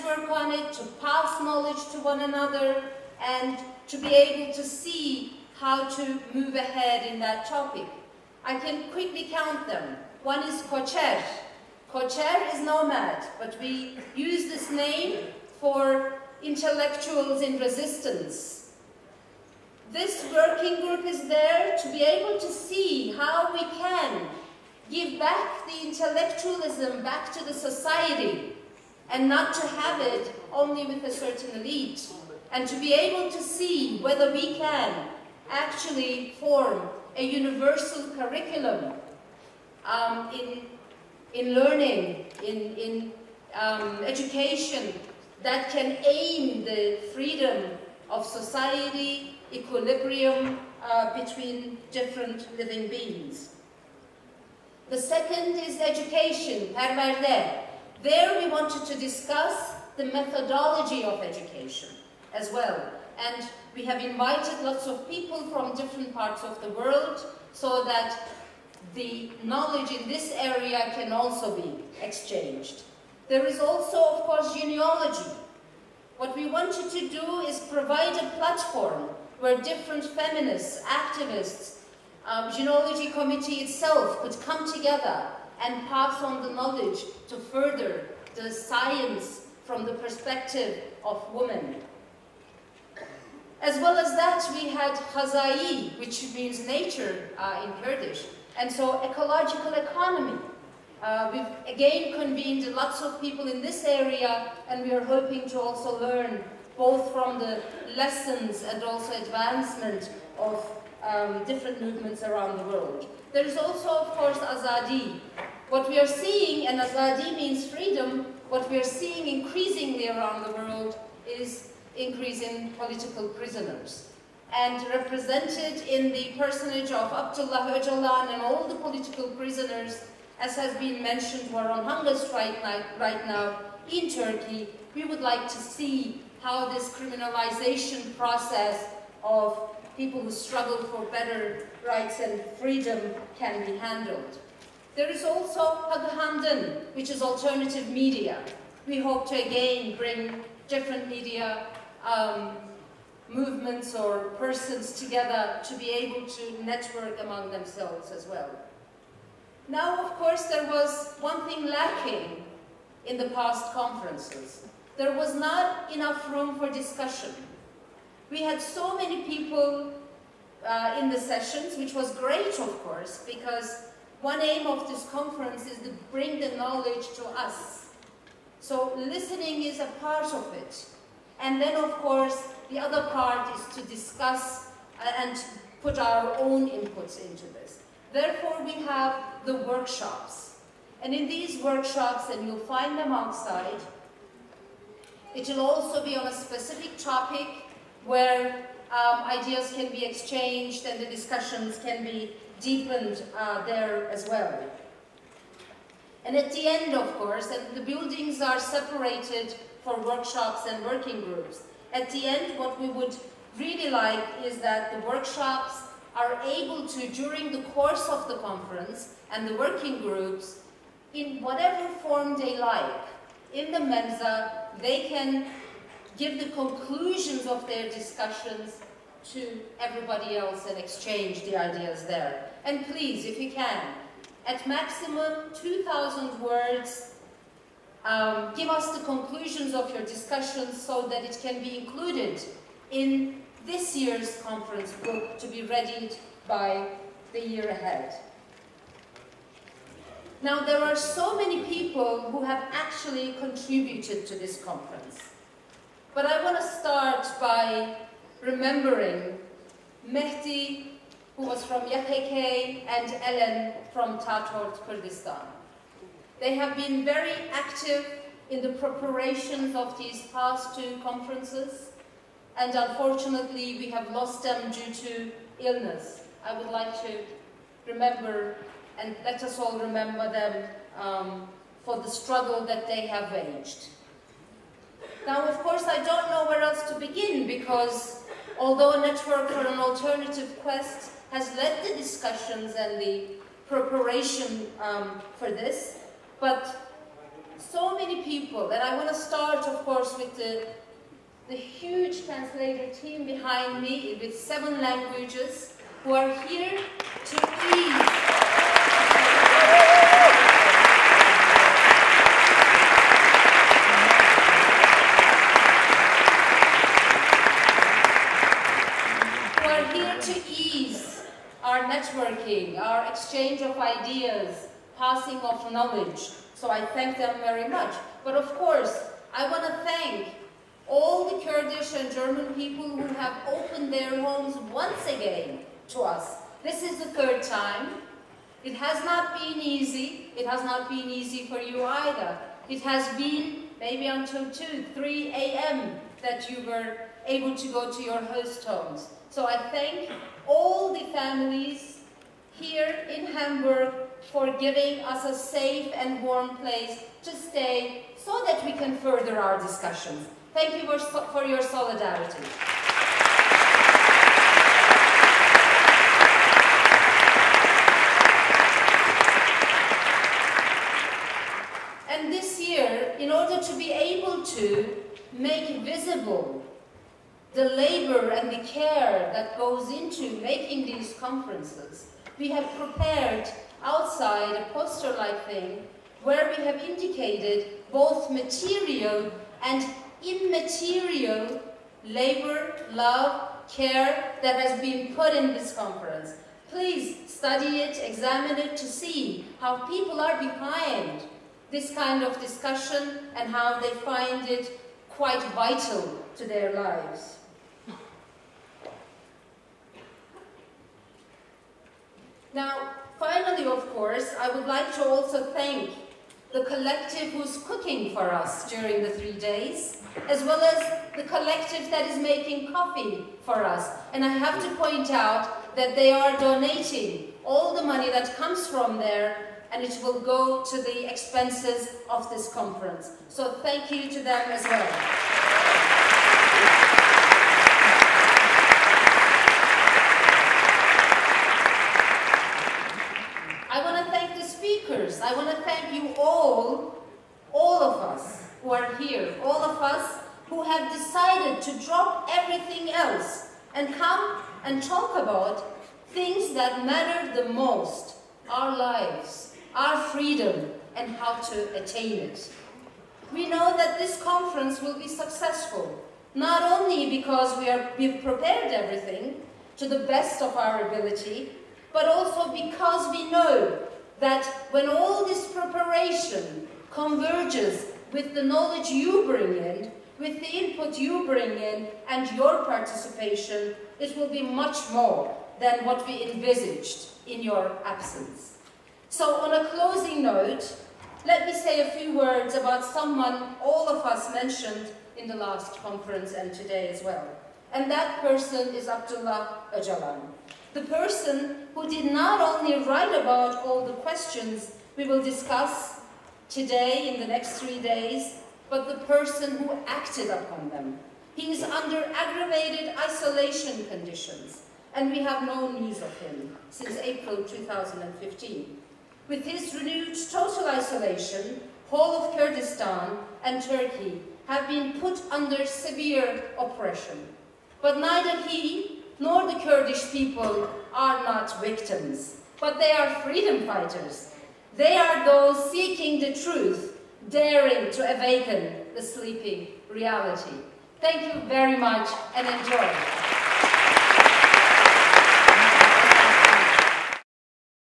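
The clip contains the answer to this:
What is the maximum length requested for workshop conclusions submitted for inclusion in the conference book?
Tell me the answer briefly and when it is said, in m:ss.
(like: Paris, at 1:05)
2,000 words, at 3:55.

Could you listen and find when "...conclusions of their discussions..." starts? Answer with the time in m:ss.
3:46.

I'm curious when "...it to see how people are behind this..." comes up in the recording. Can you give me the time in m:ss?
6:38.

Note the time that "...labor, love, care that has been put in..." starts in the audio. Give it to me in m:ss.
6:32.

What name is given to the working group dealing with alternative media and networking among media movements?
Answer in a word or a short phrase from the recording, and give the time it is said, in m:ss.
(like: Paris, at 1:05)
Haghamdan, at 2:25.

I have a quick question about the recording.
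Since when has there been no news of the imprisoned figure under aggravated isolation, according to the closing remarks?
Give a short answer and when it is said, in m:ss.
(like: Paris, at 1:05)
April 2015, at 8:36.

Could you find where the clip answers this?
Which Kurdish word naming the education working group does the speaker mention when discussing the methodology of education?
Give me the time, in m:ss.
0:56.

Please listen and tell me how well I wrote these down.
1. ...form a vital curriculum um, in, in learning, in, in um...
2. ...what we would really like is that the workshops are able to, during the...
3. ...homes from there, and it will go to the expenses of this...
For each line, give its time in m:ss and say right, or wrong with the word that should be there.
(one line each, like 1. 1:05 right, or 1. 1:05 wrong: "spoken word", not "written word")
1. 0:36 wrong: "universal", not "vital"
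2. 3:32 right
3. 7:08 wrong: "comes", not "homes".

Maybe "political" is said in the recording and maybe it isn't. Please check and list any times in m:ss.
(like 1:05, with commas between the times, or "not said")
2:02, 2:08.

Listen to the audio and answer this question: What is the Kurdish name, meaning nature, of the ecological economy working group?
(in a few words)
Haza'i.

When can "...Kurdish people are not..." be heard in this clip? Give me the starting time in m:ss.
8:49.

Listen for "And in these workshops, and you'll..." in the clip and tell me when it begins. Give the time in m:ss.
3:11.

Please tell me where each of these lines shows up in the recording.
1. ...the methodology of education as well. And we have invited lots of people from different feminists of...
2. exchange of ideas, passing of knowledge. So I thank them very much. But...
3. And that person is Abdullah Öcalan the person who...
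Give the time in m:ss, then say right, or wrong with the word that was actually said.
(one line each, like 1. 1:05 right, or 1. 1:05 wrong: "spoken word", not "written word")
1. 0:59 wrong: "parts", not "feminists"
2. 5:23 right
3. 8:17 right.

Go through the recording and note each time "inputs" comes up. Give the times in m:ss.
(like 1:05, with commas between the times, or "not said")
3:06, 8:00.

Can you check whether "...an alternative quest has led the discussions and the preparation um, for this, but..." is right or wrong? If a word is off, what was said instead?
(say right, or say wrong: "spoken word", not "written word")
right.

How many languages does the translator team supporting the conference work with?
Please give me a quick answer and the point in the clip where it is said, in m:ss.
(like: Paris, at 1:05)
7, at 5:04.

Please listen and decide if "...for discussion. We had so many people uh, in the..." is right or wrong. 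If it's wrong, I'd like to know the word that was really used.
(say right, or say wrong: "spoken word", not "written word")
right.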